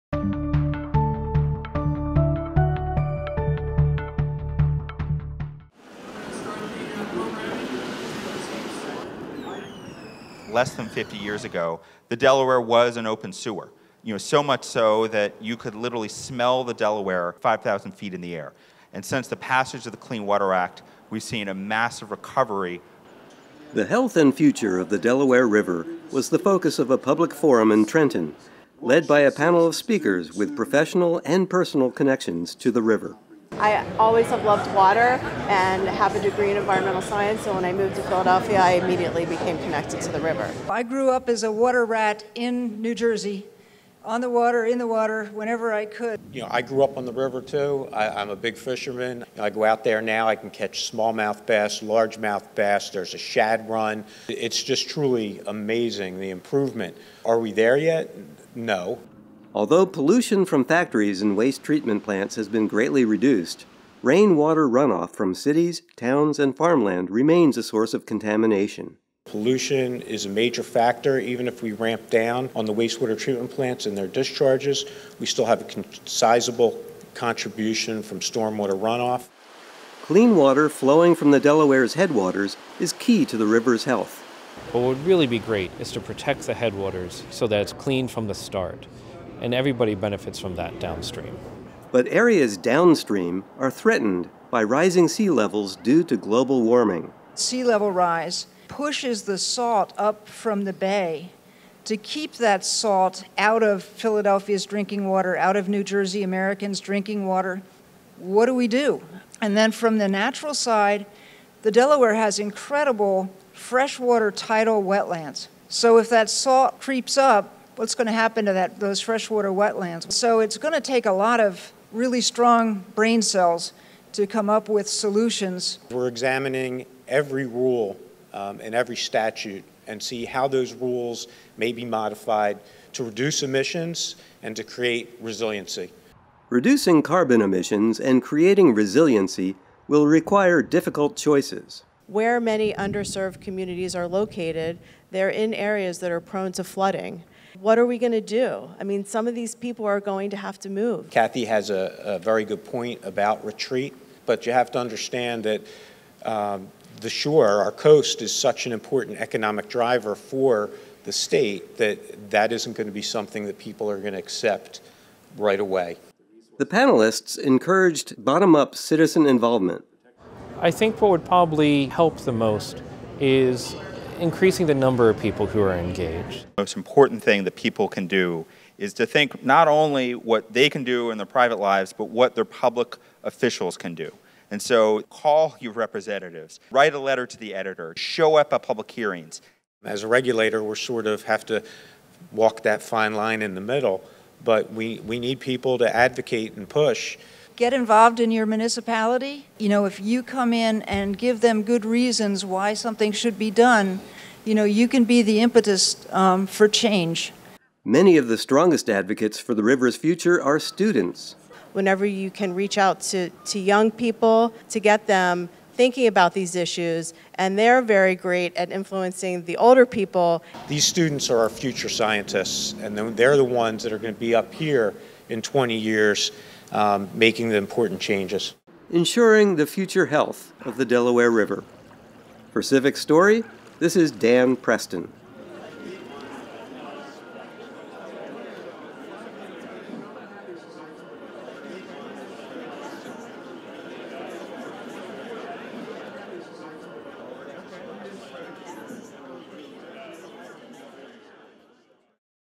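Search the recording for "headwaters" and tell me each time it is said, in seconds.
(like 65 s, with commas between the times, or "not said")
81 s, 86 s.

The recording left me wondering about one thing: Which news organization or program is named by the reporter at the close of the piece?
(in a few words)
CivicStory.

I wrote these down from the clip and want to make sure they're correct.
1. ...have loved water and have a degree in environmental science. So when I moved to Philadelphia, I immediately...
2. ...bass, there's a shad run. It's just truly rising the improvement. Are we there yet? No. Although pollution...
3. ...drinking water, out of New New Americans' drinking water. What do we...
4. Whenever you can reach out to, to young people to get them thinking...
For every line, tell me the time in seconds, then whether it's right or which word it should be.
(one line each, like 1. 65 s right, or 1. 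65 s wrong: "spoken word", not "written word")
1. 34 s right
2. 52 s wrong: "amazing", not "rising"
3. 104 s wrong: "Jersey", not "New"
4. 211 s right.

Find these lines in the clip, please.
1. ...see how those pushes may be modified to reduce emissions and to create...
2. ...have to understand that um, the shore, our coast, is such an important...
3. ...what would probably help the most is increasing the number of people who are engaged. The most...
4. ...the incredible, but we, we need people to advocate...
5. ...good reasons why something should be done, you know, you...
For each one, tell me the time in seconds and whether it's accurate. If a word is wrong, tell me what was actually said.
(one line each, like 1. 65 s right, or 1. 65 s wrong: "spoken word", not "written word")
1. 130 s wrong: "rules", not "pushes"
2. 154 s right
3. 171 s right
4. 193 s wrong: "middle", not "incredible"
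5. 201 s right.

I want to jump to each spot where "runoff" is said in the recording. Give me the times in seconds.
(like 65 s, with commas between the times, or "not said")
64 s, 78 s.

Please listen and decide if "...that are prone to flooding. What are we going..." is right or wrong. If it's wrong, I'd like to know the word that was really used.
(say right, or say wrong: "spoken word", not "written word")
right.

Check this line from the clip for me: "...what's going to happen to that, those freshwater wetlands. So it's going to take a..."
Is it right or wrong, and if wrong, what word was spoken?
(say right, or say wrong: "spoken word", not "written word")
right.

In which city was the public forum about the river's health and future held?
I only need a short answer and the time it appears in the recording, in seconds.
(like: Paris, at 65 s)
Trenton, at 27 s.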